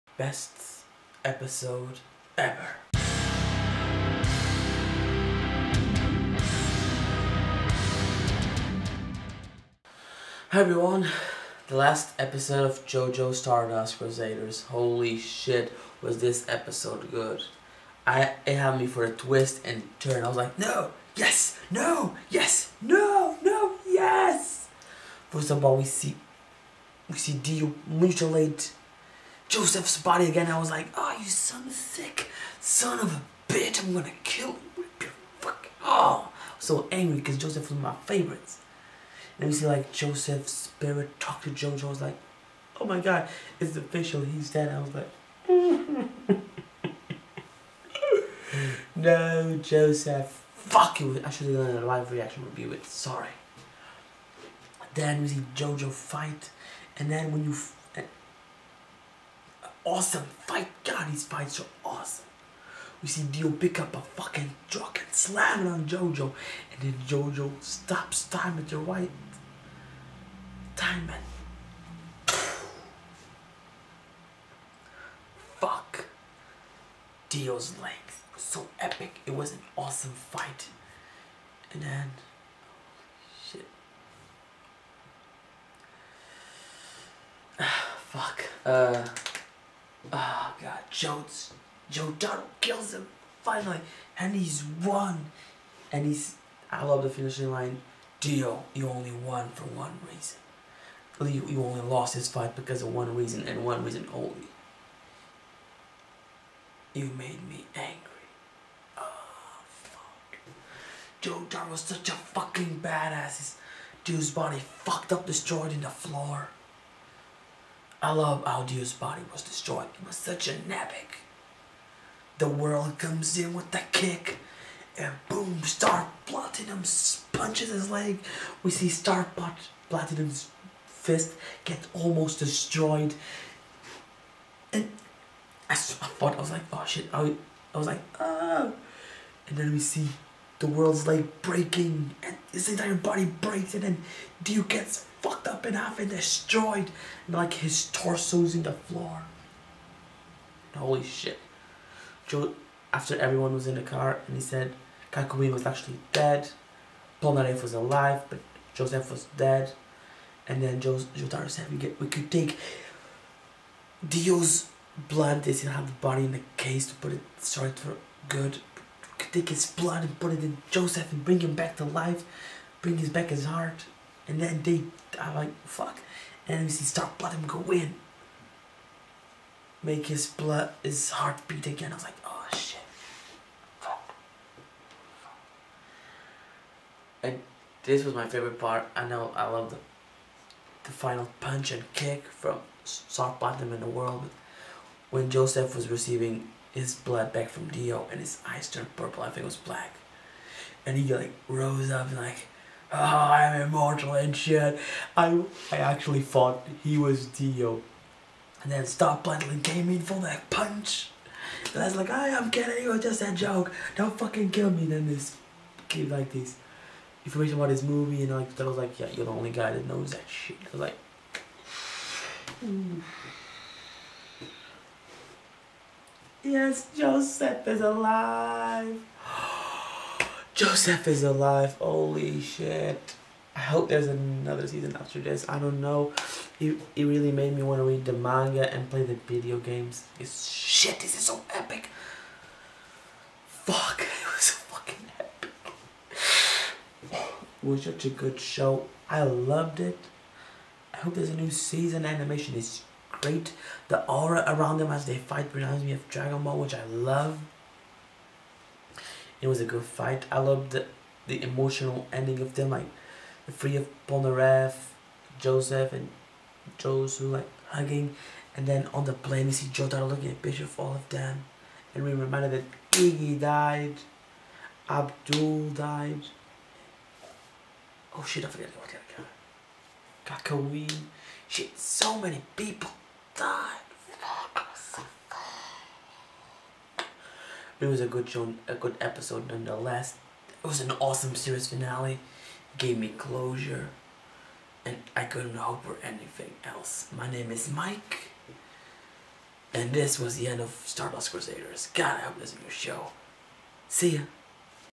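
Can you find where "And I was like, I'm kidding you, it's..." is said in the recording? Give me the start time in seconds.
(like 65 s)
211 s.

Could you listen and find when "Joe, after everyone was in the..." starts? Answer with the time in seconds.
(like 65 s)
152 s.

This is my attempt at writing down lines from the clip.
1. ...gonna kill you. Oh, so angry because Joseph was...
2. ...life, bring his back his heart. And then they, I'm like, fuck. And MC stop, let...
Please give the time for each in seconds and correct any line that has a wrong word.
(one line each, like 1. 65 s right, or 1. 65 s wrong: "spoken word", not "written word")
1. 33 s right
2. 171 s right.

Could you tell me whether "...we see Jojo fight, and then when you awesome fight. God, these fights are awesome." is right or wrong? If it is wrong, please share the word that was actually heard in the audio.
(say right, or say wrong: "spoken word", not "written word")
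right.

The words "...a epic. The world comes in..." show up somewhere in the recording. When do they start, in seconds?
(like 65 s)
120 s.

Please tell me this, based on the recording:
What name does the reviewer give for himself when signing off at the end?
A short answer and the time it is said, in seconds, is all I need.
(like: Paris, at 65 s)
Mike, at 297 s.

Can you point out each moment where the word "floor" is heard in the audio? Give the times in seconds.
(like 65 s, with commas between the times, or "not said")
115 s, 148 s.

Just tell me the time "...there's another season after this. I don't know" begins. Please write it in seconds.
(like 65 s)
233 s.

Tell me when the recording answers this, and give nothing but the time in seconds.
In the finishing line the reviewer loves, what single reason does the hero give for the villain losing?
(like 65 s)
106 s.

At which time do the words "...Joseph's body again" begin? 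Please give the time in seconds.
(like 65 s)
29 s.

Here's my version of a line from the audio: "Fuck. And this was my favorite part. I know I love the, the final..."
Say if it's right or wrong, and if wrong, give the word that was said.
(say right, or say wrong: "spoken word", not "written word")
right.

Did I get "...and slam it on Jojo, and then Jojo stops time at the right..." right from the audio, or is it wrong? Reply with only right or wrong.
right.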